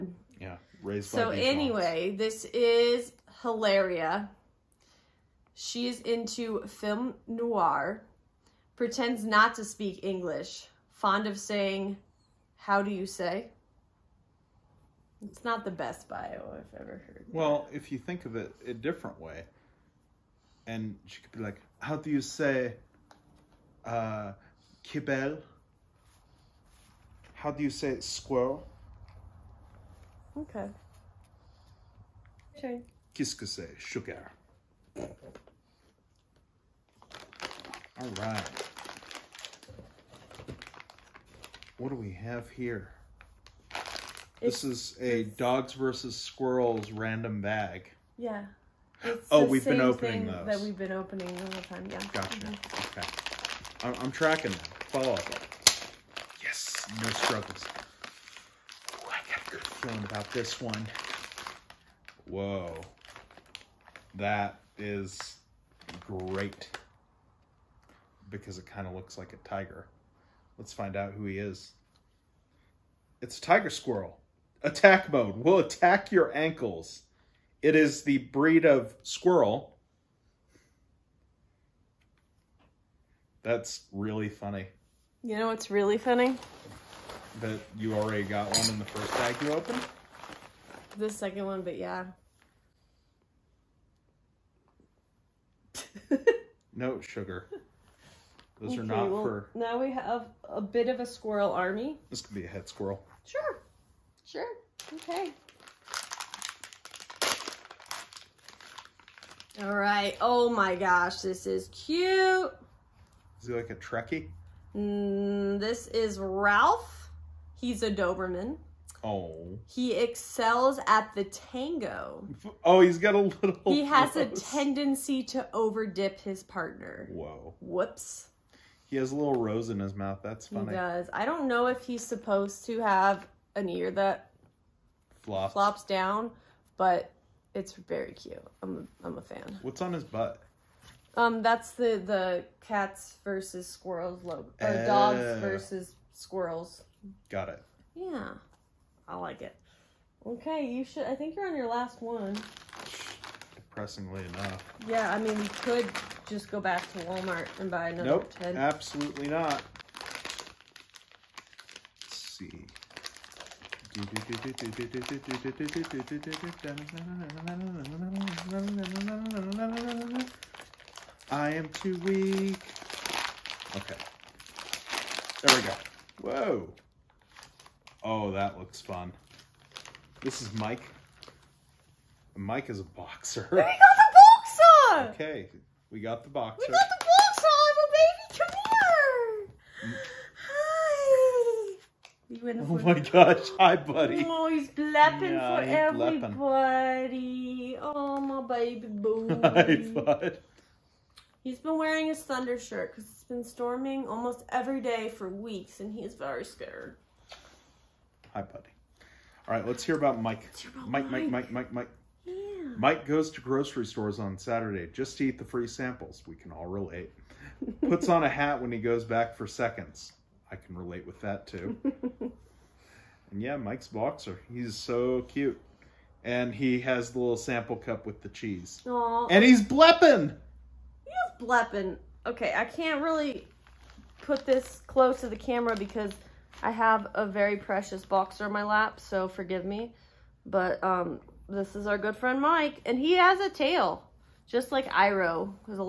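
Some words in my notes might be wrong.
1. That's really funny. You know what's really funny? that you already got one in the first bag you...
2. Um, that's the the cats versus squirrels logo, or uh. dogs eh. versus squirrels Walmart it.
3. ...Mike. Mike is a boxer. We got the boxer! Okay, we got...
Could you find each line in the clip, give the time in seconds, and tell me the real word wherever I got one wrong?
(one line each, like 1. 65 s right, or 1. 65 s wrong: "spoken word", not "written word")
1. 83 s right
2. 141 s wrong: "Got", not "Walmart"
3. 180 s right.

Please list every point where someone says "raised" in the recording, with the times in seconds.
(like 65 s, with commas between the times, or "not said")
0 s.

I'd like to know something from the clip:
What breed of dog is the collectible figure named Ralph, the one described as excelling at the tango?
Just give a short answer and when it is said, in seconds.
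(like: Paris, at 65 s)
Doberman, at 117 s.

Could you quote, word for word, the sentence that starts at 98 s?
Those okay, are not well, for.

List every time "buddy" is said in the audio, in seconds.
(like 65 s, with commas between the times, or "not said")
193 s, 208 s.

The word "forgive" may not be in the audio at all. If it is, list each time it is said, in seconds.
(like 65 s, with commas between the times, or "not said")
239 s.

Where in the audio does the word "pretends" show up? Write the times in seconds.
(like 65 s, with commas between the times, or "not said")
8 s.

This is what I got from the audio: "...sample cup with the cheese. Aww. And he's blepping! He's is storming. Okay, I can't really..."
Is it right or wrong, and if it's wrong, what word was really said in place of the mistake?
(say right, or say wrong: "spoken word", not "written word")
wrong: "blepping", not "storming".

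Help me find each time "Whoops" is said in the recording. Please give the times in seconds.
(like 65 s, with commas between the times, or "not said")
127 s.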